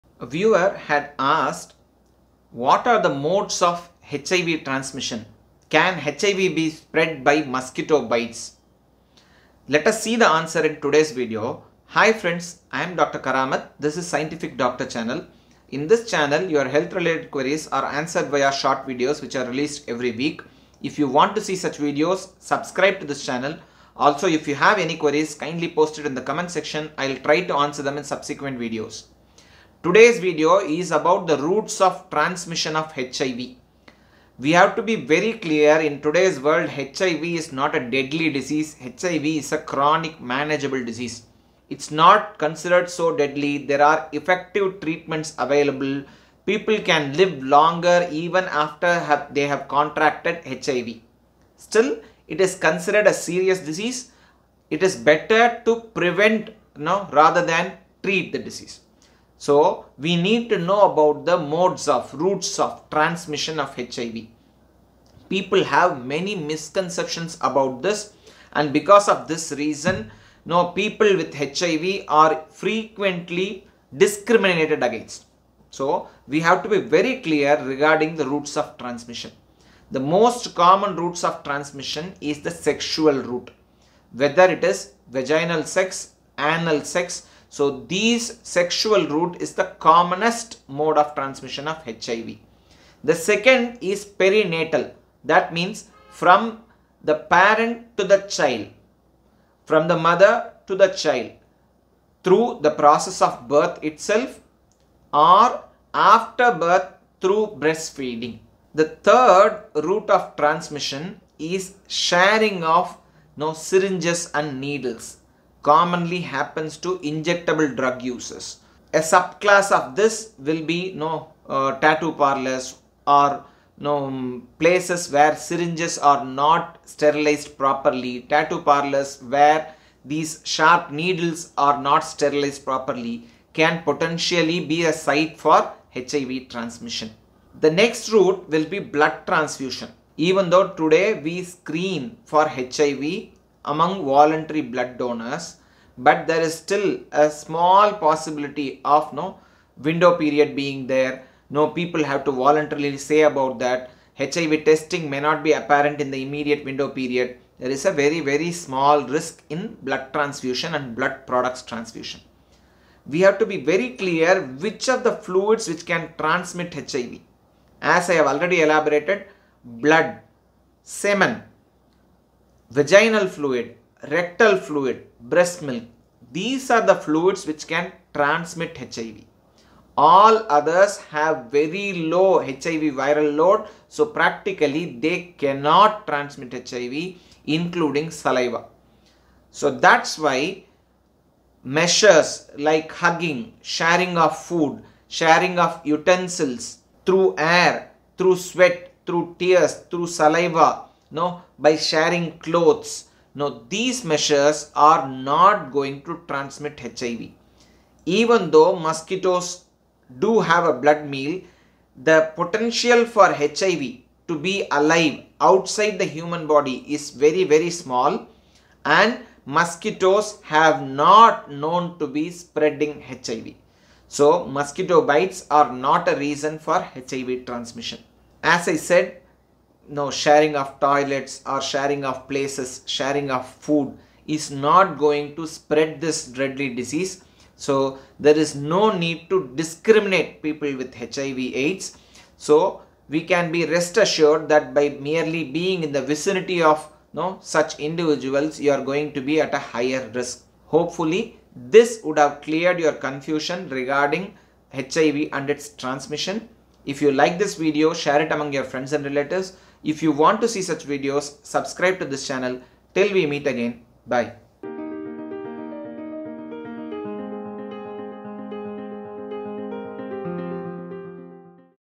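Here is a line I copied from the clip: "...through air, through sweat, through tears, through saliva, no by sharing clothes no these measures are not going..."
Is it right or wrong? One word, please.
right.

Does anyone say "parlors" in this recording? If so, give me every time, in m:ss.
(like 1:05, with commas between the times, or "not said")
2:02, 2:08.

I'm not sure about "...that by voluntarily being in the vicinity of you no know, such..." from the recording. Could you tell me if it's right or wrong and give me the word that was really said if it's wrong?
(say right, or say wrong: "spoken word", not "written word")
wrong: "merely", not "voluntarily".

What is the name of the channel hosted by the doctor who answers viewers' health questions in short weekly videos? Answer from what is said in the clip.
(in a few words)
Scientific Doctor.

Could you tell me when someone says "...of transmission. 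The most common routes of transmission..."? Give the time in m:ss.
1:18.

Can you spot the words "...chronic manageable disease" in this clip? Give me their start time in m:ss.
0:39.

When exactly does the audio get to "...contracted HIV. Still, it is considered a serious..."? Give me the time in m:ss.
0:49.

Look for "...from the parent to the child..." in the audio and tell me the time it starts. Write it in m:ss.
1:36.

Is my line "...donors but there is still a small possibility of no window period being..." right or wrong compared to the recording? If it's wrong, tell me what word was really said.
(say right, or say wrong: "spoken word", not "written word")
right.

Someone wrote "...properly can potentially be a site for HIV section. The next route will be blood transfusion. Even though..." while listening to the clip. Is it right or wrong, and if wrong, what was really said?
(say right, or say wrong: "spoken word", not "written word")
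wrong: "transmission", not "section".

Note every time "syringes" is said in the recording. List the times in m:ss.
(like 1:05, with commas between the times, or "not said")
1:53, 2:05.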